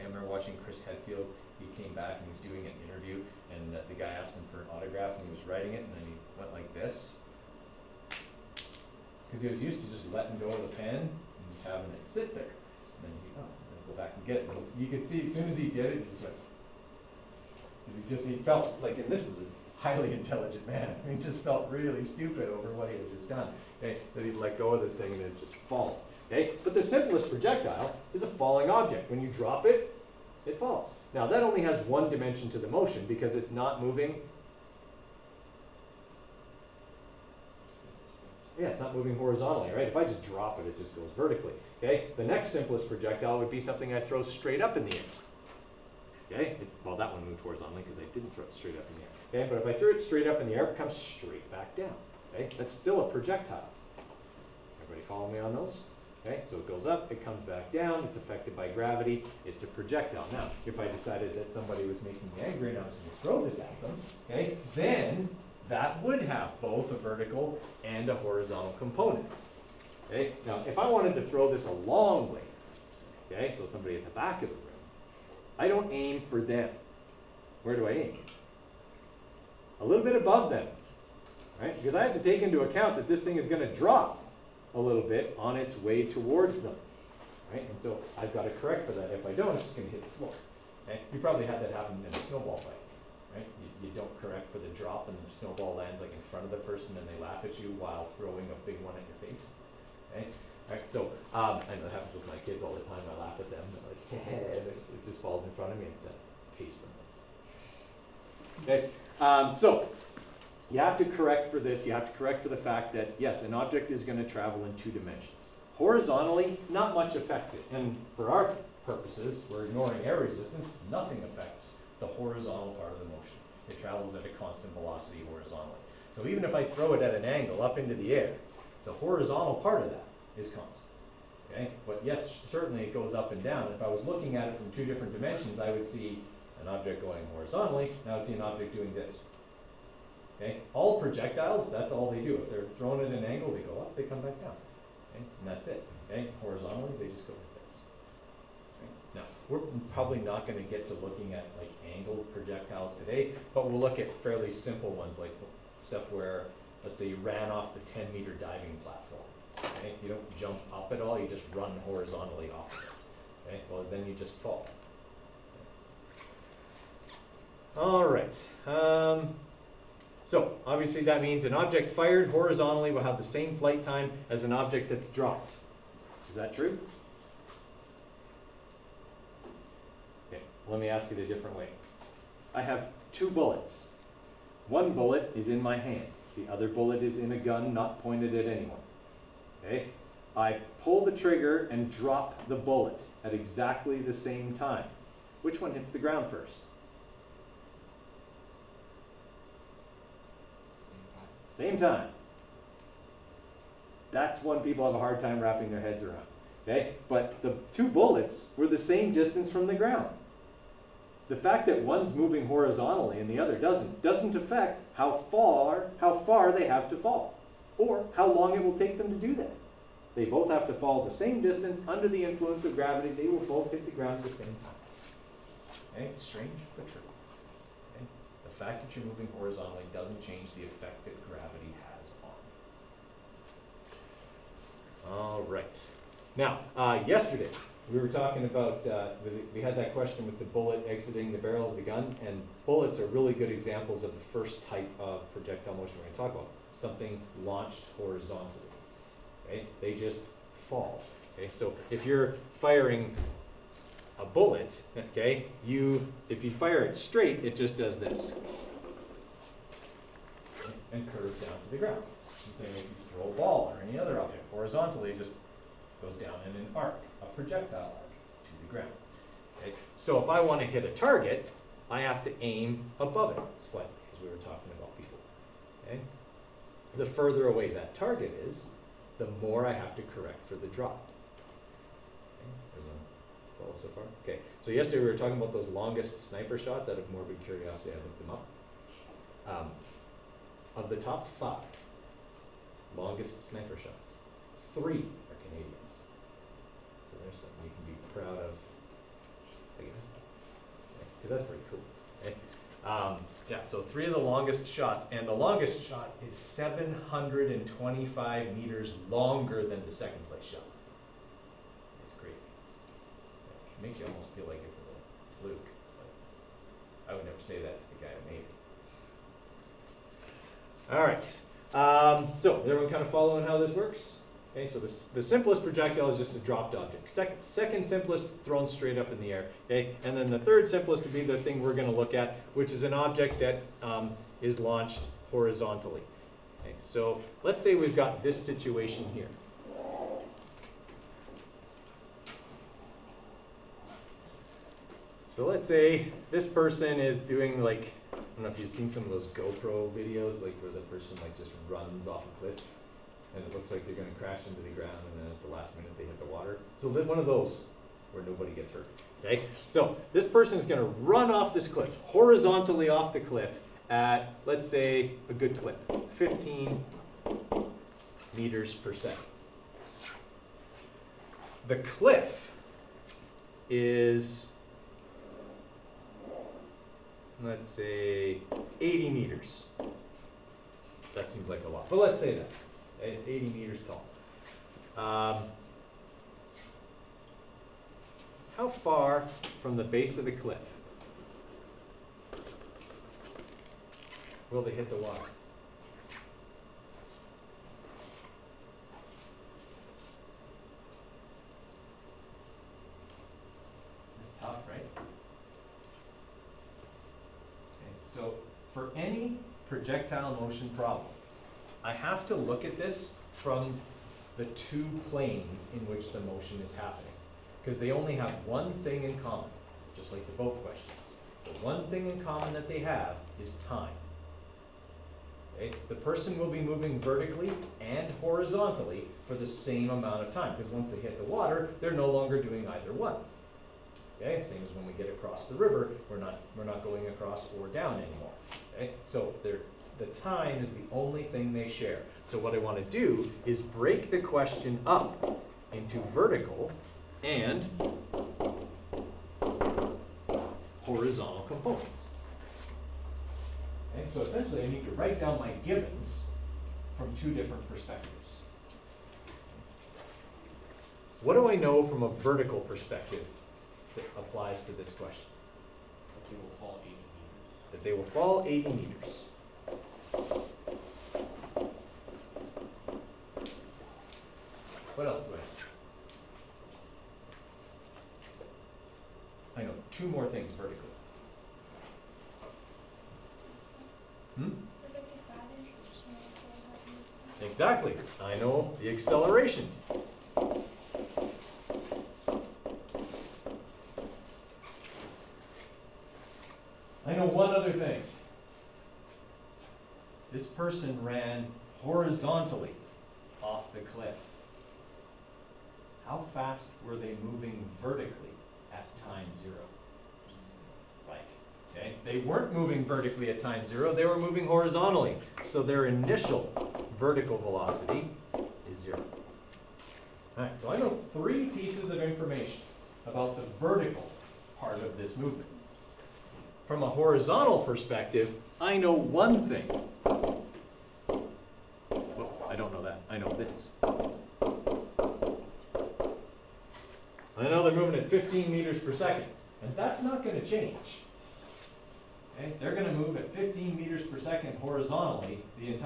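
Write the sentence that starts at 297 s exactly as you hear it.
So there's something you can be proud of, I guess.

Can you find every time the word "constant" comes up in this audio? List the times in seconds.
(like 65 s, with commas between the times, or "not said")
124 s, 130 s.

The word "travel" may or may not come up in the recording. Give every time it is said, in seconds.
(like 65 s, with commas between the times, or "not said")
114 s, 123 s.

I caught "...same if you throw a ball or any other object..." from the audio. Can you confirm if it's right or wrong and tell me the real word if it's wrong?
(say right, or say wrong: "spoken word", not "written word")
right.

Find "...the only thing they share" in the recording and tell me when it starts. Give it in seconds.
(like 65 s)
440 s.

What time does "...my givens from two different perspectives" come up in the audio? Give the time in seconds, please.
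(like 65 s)
455 s.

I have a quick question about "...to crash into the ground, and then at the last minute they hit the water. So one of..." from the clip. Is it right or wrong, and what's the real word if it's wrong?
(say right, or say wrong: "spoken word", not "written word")
right.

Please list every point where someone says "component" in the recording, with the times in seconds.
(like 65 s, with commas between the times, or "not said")
68 s, 451 s.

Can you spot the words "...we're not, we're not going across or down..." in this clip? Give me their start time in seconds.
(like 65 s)
436 s.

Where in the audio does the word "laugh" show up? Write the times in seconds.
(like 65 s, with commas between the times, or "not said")
97 s, 103 s.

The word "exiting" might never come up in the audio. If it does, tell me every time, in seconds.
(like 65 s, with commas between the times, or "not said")
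240 s.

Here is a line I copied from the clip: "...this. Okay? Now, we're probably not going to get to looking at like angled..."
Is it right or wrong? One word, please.
right.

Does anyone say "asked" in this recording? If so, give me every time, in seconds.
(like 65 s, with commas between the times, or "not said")
4 s.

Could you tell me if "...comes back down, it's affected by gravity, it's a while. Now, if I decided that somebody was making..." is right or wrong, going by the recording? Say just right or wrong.
wrong.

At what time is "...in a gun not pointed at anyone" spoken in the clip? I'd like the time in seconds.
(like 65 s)
187 s.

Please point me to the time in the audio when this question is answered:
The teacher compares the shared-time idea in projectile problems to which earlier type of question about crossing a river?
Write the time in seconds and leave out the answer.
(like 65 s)
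420 s.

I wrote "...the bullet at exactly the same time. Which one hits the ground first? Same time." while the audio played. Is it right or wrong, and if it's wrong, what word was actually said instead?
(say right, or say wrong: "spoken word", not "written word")
right.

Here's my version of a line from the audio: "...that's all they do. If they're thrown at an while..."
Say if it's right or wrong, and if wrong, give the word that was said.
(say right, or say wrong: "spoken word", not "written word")
wrong: "angle", not "while".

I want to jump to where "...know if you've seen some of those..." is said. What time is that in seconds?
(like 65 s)
348 s.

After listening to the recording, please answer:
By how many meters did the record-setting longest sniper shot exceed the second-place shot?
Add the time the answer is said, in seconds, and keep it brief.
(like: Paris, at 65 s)
725 meters, at 306 s.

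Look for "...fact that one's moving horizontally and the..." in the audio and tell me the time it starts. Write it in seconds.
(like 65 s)
211 s.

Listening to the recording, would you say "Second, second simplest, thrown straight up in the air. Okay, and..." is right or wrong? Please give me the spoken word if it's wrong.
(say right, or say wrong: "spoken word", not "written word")
right.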